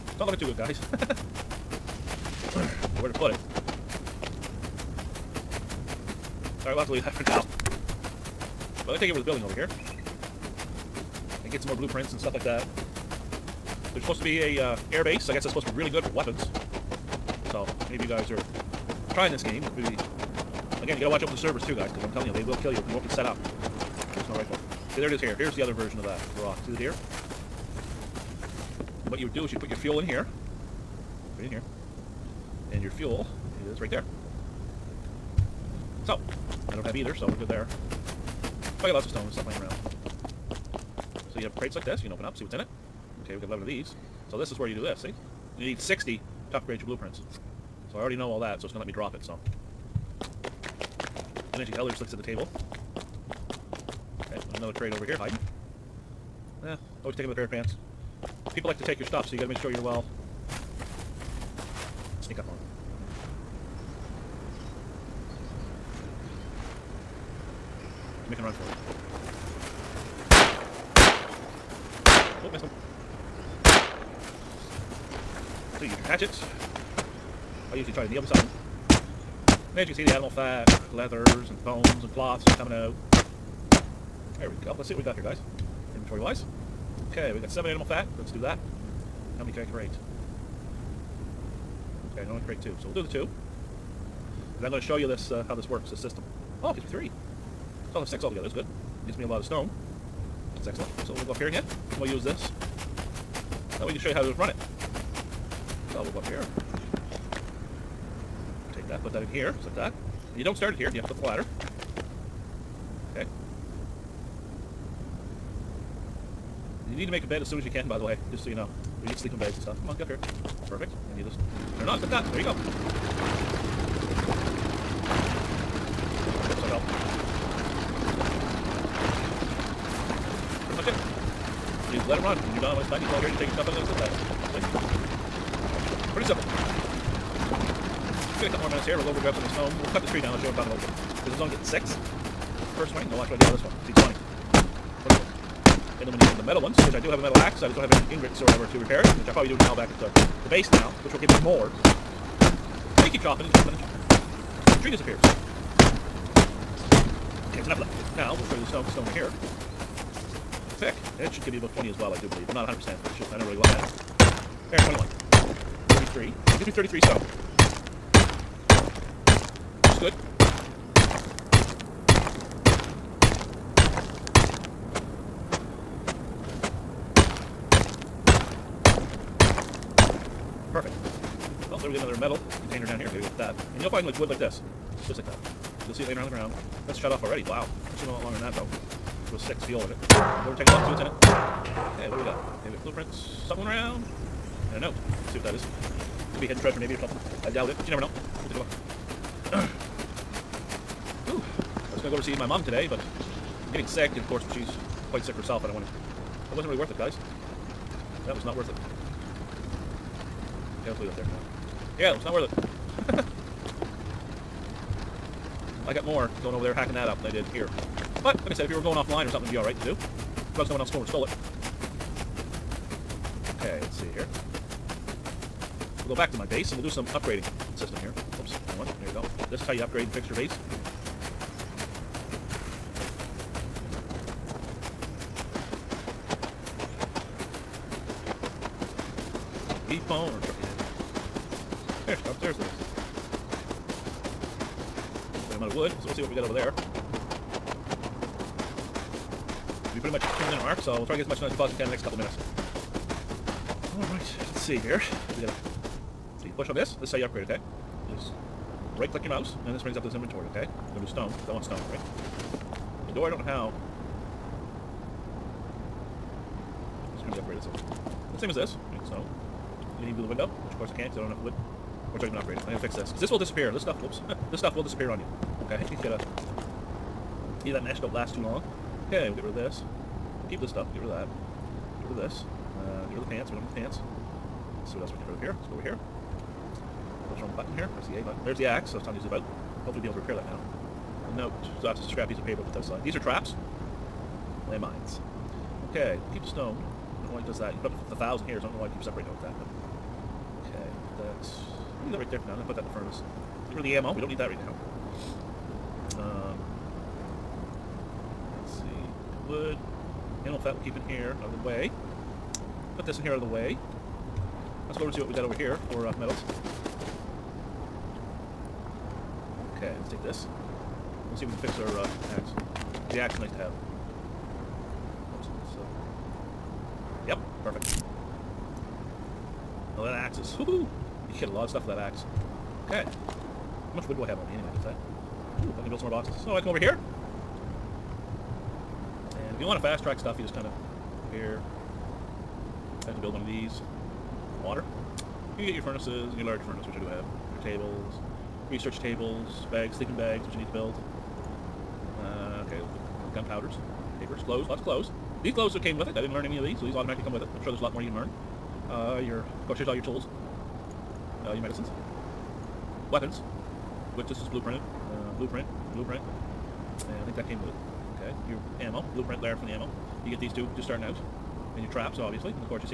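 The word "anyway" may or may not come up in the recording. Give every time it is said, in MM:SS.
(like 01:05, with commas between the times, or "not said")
05:34.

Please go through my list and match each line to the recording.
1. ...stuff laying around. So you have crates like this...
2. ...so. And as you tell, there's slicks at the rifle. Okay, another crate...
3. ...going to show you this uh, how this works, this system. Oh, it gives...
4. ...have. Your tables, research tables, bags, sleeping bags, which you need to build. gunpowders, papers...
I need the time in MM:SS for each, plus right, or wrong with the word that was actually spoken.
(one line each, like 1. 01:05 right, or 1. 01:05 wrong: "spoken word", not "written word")
1. 00:39 right
2. 00:49 wrong: "table", not "rifle"
3. 01:34 right
4. 05:47 right.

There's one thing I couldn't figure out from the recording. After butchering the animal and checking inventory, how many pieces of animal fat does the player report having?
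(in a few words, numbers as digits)
7.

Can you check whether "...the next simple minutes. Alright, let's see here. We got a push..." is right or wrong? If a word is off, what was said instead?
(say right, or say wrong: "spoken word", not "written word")
wrong: "couple", not "simple".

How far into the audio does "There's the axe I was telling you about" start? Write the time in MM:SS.
04:48.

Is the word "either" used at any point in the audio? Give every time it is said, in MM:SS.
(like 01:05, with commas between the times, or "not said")
00:36, 04:37.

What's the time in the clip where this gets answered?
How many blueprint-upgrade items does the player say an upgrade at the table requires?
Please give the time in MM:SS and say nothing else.
00:45.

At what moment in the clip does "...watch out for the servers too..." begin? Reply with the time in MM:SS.
00:21.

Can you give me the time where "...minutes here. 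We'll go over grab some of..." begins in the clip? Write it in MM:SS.
02:18.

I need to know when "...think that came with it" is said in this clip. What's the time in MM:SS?
06:07.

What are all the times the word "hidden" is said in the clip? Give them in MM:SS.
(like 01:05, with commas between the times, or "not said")
03:16.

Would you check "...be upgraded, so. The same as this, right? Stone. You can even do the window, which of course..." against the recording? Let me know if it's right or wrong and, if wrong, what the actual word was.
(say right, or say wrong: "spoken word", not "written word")
right.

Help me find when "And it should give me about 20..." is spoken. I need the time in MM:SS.
02:41.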